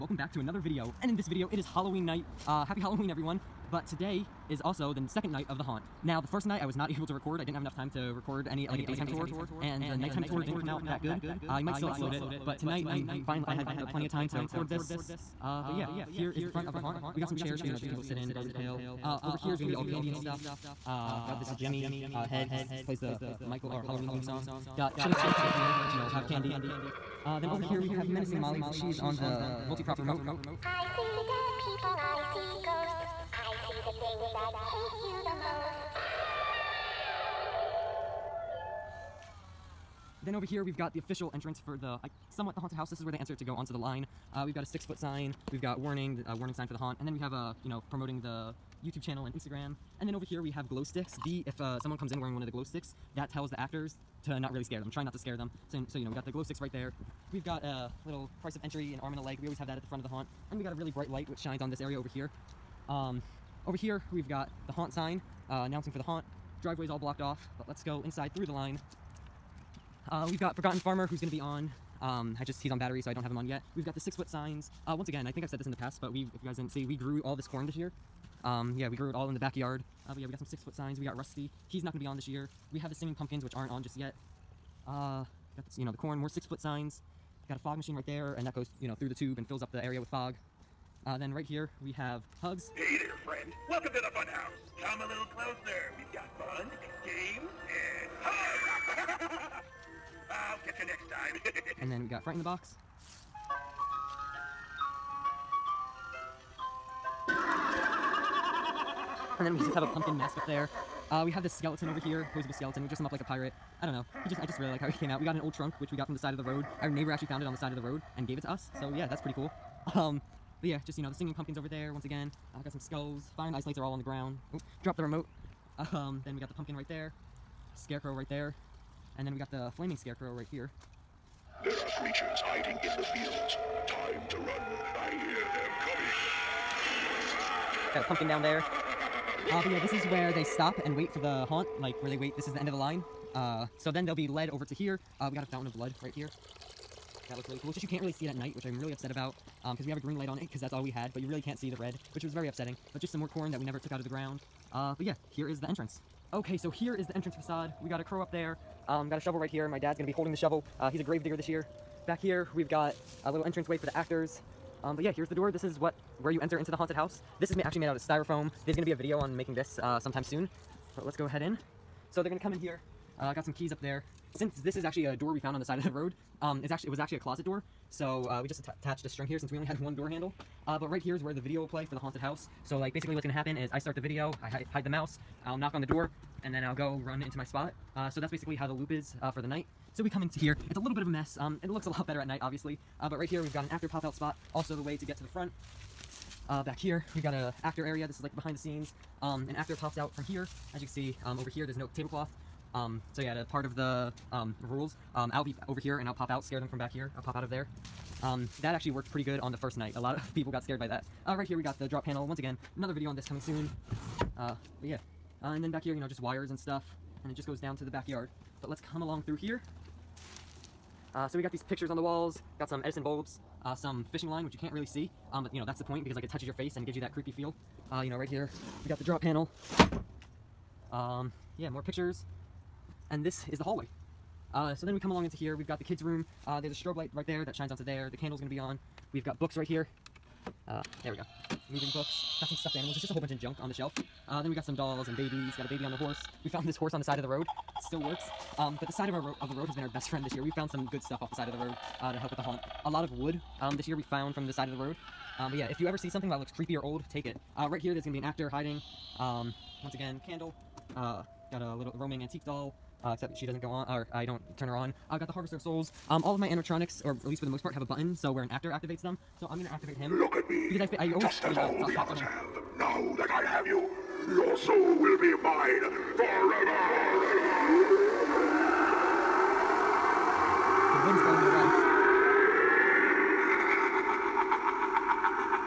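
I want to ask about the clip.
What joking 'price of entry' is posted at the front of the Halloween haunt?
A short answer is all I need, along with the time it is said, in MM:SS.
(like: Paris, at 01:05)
An arm and a leg, at 00:58.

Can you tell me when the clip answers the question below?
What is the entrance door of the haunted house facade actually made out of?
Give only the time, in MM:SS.
02:47.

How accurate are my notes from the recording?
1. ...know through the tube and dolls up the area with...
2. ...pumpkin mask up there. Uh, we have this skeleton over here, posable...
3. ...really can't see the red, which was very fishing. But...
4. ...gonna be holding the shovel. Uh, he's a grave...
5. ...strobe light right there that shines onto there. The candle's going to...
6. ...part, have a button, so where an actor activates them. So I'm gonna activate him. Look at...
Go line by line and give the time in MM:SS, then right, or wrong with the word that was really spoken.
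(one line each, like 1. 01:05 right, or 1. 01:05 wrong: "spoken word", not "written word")
1. 01:28 wrong: "fills", not "dolls"
2. 01:49 right
3. 02:31 wrong: "upsetting", not "fishing"
4. 02:39 right
5. 03:56 right
6. 04:27 right.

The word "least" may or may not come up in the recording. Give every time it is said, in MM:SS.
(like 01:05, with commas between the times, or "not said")
04:27.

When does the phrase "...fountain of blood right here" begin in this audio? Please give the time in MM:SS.
02:25.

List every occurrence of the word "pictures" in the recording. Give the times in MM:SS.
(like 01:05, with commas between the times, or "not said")
03:41, 03:51.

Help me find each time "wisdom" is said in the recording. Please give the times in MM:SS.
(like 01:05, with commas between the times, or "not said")
not said.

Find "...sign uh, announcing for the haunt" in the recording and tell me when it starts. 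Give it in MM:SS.
01:04.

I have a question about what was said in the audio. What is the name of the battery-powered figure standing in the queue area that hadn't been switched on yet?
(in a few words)
Forgotten Farmer.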